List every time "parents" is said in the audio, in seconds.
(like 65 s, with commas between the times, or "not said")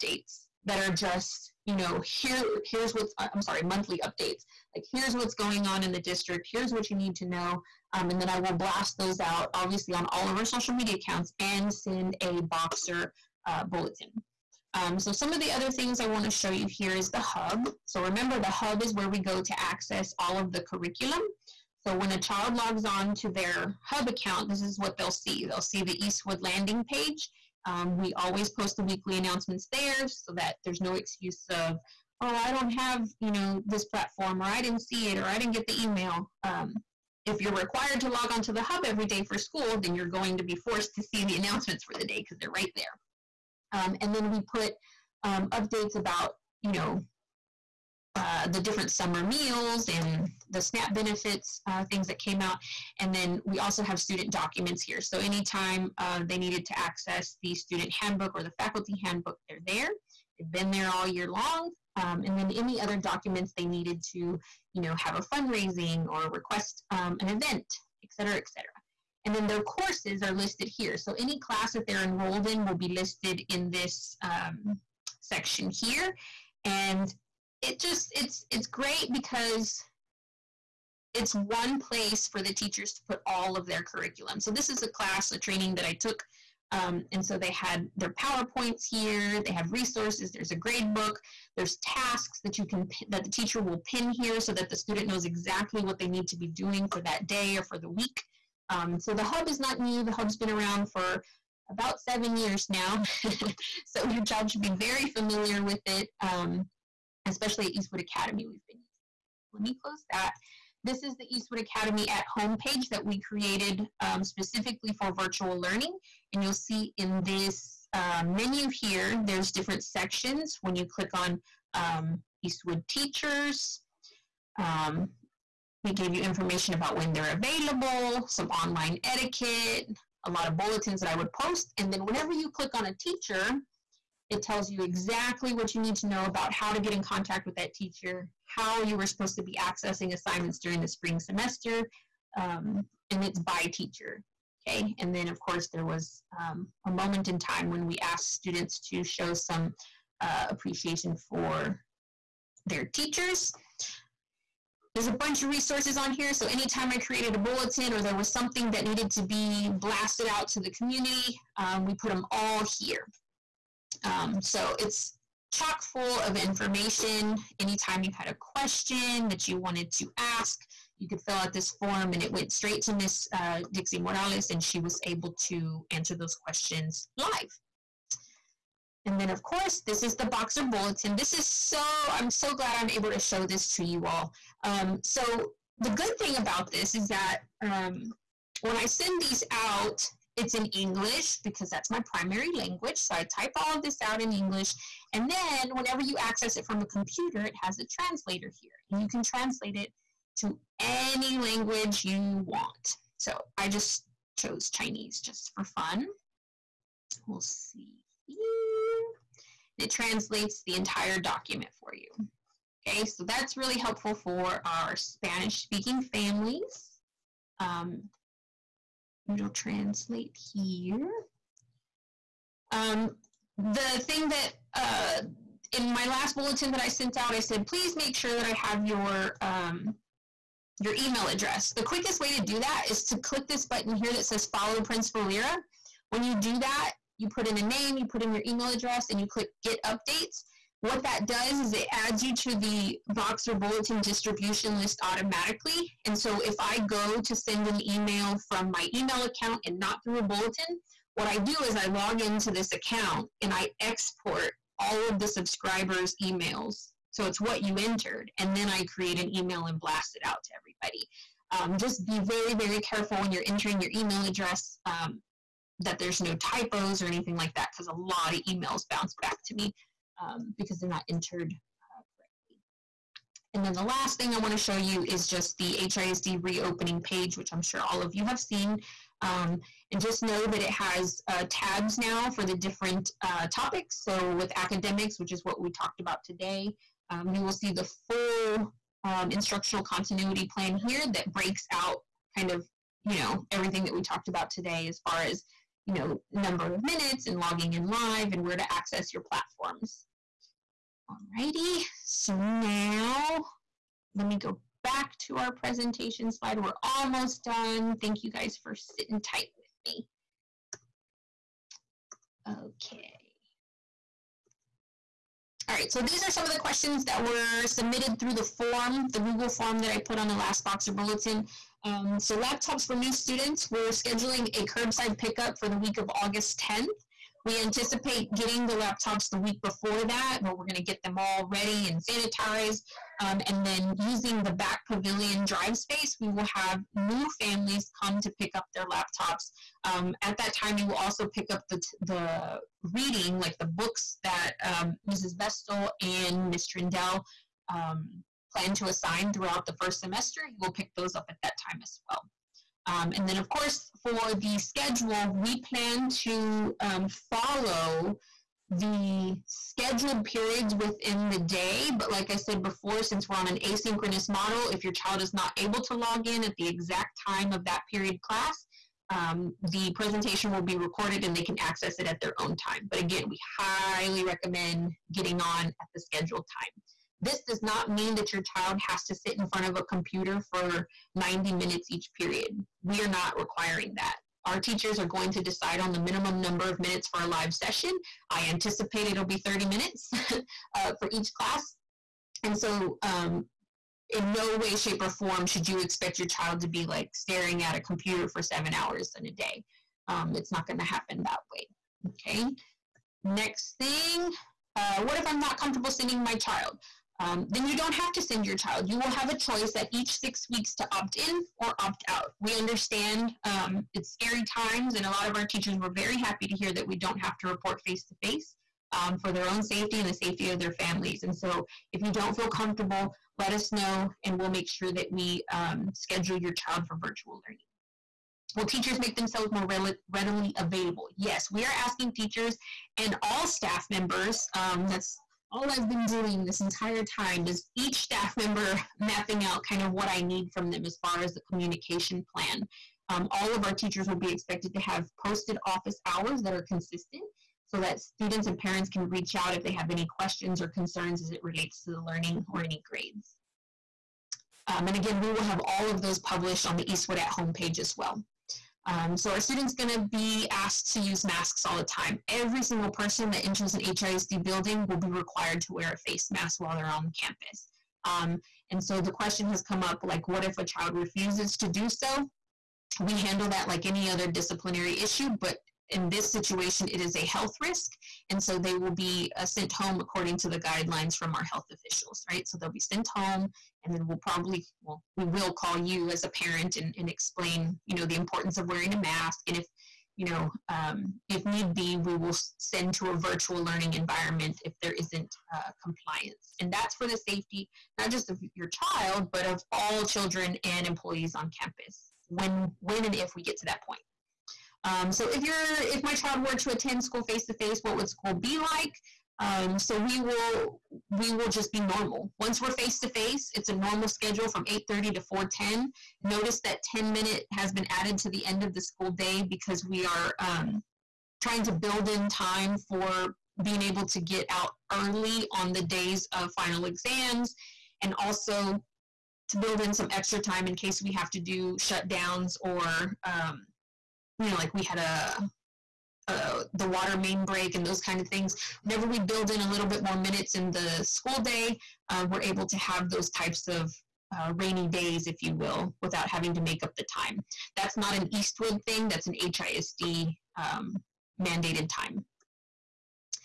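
448 s, 486 s.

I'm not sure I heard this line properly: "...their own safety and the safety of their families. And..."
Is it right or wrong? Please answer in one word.
right.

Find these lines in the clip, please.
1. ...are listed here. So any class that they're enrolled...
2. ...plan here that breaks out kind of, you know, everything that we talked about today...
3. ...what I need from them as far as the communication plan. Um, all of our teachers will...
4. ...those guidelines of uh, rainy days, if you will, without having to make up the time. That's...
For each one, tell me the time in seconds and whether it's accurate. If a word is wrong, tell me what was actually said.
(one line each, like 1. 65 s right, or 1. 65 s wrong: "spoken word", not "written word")
1. 70 s right
2. 290 s right
3. 439 s right
4. 543 s wrong: "types", not "guidelines".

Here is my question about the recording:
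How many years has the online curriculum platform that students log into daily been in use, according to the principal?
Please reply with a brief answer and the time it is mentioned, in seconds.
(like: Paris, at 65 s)
7, at 101 s.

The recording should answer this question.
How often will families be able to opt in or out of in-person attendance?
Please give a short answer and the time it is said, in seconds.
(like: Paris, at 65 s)
each six weeks, at 409 s.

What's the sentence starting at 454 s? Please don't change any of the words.
Um, and again, we will have all of those published on the Eastwood at Home page as well.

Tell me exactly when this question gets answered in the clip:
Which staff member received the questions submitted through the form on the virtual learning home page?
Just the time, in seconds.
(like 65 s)
173 s.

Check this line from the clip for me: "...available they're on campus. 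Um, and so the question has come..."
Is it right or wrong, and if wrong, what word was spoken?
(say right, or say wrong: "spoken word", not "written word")
wrong: "while", not "available".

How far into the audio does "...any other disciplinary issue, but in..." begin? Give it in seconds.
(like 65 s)
473 s.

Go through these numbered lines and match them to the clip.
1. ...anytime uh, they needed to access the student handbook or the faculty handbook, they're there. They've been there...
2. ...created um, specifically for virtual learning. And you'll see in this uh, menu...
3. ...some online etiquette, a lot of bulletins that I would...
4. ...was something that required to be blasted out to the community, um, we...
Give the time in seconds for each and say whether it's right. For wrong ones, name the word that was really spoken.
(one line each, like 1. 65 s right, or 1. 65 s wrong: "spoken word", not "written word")
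1. 55 s right
2. 113 s right
3. 128 s right
4. 158 s wrong: "needed", not "required".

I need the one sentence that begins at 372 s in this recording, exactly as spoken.
But again, we highly recommend getting on at the scheduled time.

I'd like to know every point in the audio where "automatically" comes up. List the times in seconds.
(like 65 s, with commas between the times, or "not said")
245 s.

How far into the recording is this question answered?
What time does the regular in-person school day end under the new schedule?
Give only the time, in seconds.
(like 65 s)
515 s.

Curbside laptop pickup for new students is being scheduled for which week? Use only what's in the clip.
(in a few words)
August 10th.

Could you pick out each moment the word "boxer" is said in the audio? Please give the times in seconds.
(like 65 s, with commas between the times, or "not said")
12 s, 180 s, 243 s, 320 s.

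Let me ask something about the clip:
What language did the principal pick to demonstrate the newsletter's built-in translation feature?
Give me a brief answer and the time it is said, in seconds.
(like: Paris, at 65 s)
Chinese, at 204 s.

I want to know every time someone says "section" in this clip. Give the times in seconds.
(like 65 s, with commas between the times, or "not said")
75 s, 119 s.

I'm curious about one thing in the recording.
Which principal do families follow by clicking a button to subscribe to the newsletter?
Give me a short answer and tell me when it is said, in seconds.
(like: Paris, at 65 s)
Principal Lira, at 234 s.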